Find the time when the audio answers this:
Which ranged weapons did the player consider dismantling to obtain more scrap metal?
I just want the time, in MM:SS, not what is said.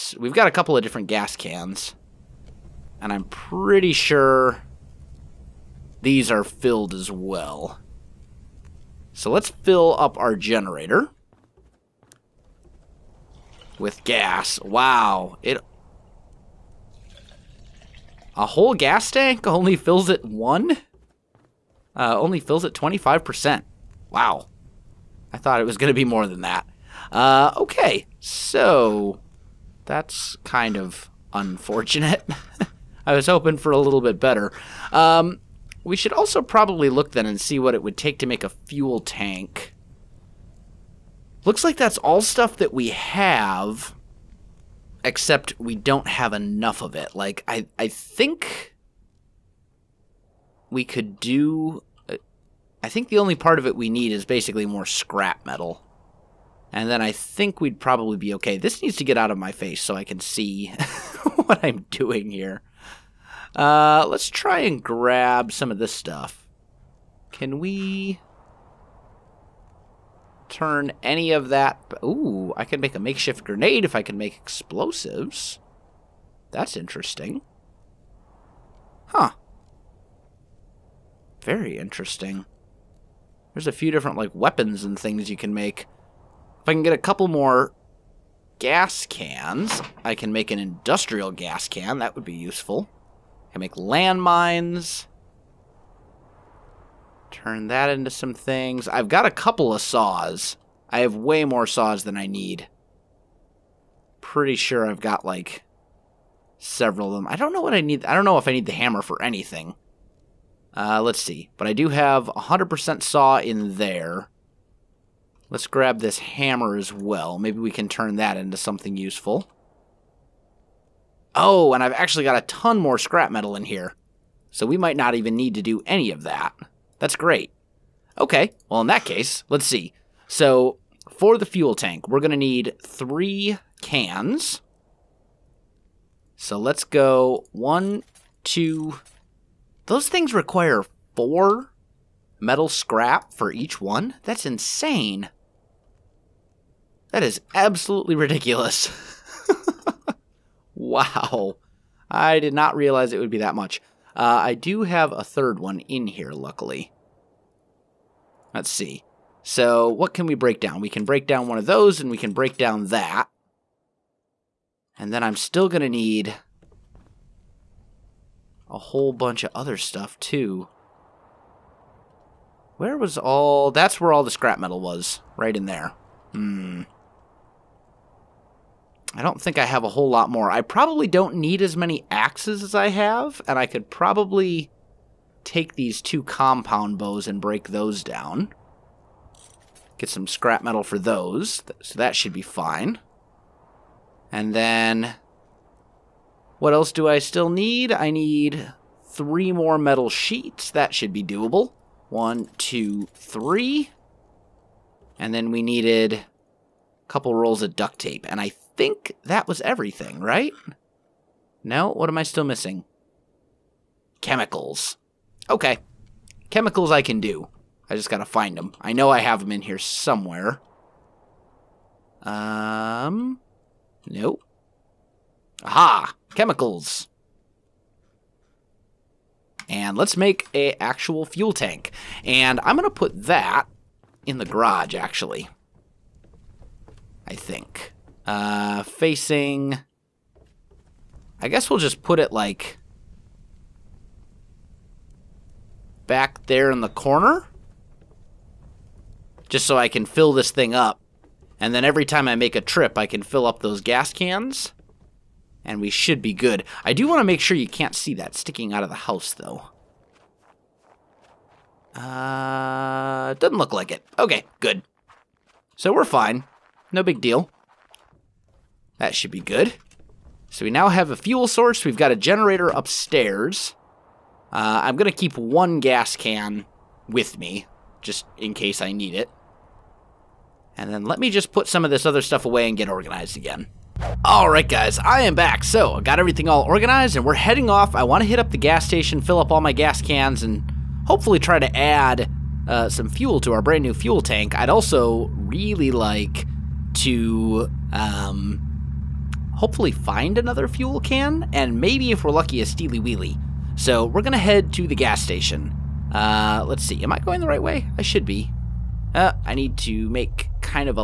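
03:06.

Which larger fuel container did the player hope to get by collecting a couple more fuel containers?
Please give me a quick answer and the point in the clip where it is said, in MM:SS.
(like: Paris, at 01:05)
Industrial gas can, at 01:30.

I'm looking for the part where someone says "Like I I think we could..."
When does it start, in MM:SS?
00:47.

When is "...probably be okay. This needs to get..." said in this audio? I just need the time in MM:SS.
00:57.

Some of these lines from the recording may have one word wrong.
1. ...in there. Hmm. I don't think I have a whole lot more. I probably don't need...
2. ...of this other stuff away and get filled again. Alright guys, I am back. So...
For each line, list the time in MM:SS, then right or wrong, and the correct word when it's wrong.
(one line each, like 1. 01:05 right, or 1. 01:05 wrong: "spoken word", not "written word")
1. 02:55 right
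2. 04:41 wrong: "organized", not "filled".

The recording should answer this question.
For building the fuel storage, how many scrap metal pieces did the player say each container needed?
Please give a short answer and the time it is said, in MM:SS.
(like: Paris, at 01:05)
4, at 02:21.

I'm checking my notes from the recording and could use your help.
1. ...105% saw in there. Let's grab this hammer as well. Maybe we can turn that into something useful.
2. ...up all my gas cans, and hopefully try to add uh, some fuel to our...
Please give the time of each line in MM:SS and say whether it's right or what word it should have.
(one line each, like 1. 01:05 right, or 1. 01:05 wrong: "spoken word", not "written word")
1. 01:52 wrong: "100", not "105"
2. 04:49 right.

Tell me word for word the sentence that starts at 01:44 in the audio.
Pretty sure I've got, like, several of them.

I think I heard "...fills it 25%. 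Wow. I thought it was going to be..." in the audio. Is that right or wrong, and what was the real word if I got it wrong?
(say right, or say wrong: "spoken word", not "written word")
right.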